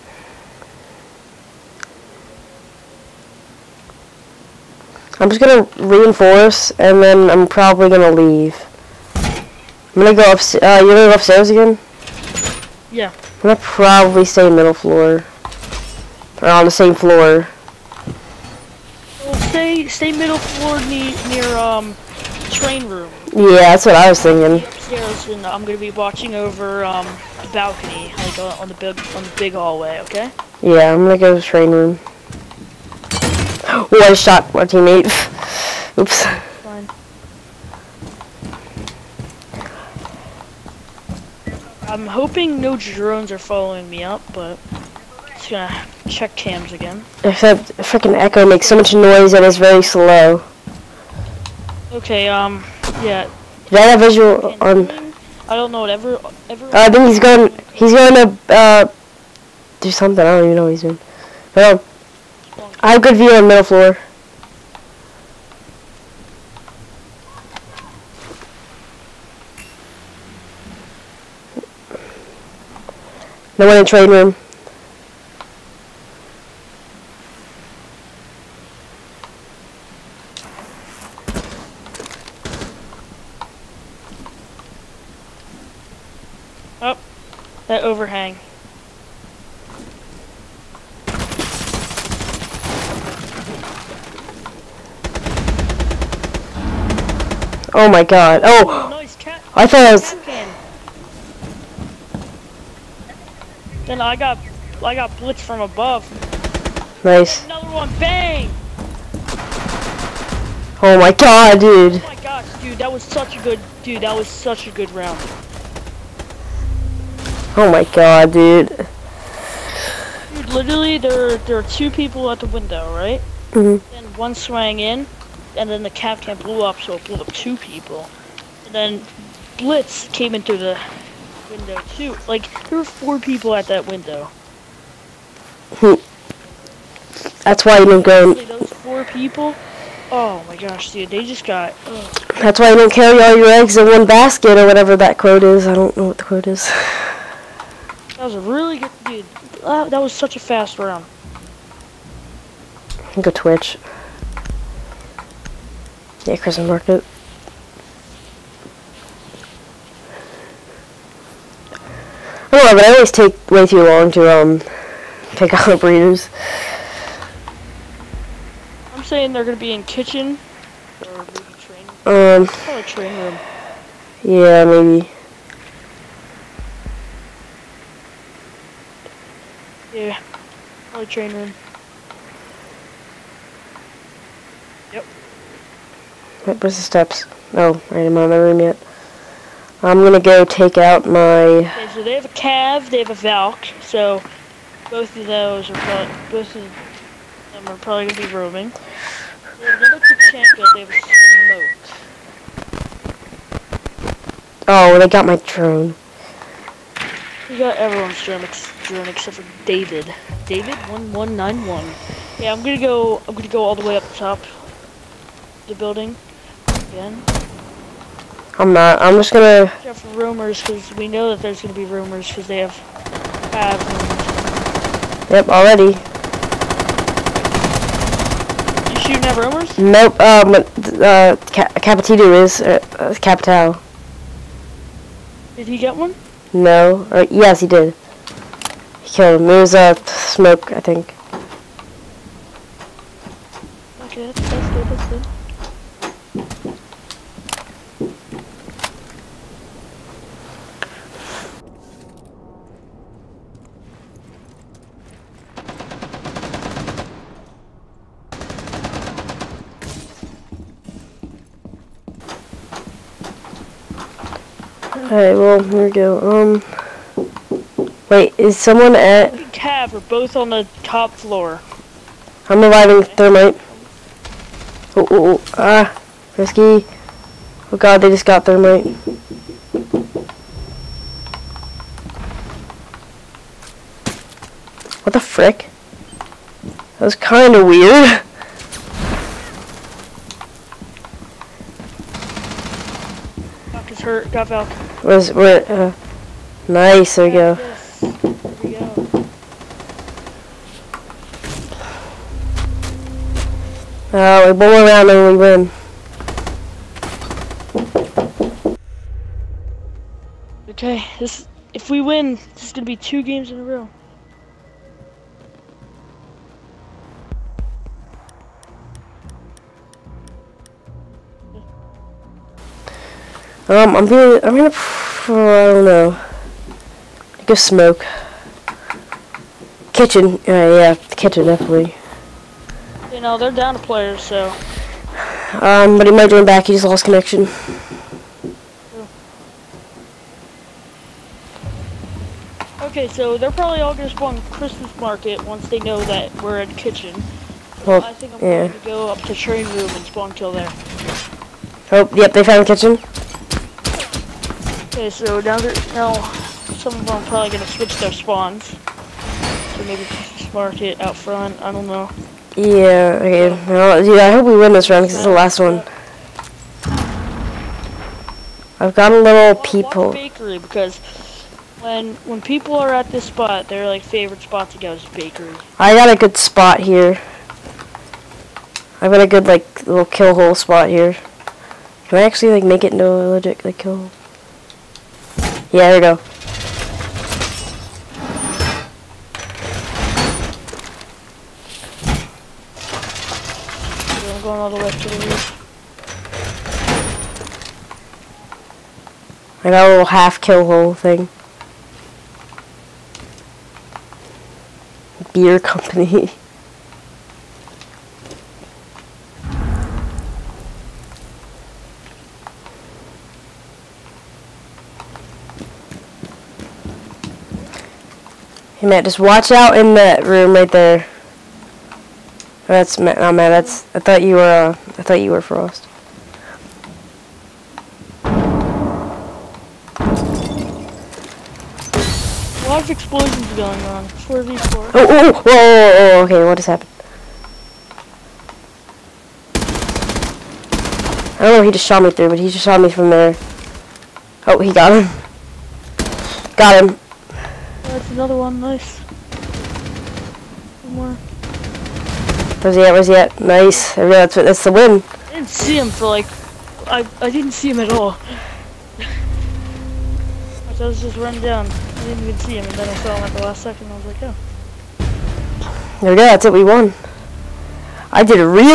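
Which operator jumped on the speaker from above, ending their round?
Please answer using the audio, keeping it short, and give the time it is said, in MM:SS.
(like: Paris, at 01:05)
Blitz, at 01:45.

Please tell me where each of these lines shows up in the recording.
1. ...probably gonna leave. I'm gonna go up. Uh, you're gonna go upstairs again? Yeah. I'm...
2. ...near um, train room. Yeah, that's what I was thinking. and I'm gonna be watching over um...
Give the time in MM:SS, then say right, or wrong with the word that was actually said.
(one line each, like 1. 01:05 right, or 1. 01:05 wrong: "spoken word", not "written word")
1. 00:07 right
2. 00:20 right.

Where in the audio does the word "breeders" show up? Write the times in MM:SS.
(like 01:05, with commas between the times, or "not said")
02:45.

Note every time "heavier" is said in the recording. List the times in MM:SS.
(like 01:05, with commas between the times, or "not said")
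not said.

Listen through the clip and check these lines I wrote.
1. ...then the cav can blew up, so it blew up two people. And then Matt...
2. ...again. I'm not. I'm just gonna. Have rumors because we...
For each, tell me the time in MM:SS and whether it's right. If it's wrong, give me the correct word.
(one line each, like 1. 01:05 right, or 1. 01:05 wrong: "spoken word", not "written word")
1. 02:05 wrong: "Blitz", not "Matt"
2. 03:36 right.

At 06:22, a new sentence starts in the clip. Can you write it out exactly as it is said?
Can I actually like make it into a legit like kill hole?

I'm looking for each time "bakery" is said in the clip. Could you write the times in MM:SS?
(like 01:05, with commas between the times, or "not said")
06:10, 06:15.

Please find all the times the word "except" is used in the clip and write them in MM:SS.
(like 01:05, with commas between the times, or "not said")
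00:47, 03:29.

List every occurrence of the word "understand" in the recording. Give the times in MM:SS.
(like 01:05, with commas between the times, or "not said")
not said.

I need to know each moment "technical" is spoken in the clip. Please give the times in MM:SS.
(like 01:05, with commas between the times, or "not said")
not said.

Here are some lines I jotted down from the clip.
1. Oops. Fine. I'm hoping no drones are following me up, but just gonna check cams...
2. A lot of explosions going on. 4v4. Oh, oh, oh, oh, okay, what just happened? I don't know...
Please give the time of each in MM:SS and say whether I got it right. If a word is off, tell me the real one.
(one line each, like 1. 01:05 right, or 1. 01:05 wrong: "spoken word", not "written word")
1. 00:35 right
2. 07:12 right.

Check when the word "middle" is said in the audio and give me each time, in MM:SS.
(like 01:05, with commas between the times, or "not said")
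00:14, 00:20, 01:03.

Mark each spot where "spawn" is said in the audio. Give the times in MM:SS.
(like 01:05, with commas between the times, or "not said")
05:44, 05:50, 05:58.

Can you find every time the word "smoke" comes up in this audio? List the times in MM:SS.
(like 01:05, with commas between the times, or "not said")
03:22, 04:00, 05:27.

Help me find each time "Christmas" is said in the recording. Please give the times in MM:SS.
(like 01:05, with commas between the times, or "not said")
02:36, 05:44.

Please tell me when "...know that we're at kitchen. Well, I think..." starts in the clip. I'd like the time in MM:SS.
05:45.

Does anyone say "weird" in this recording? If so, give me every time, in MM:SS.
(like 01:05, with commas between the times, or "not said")
04:47.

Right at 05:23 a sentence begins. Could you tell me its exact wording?
Um, I'm gonna, I'm gonna, I don't know.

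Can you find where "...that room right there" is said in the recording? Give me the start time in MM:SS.
06:59.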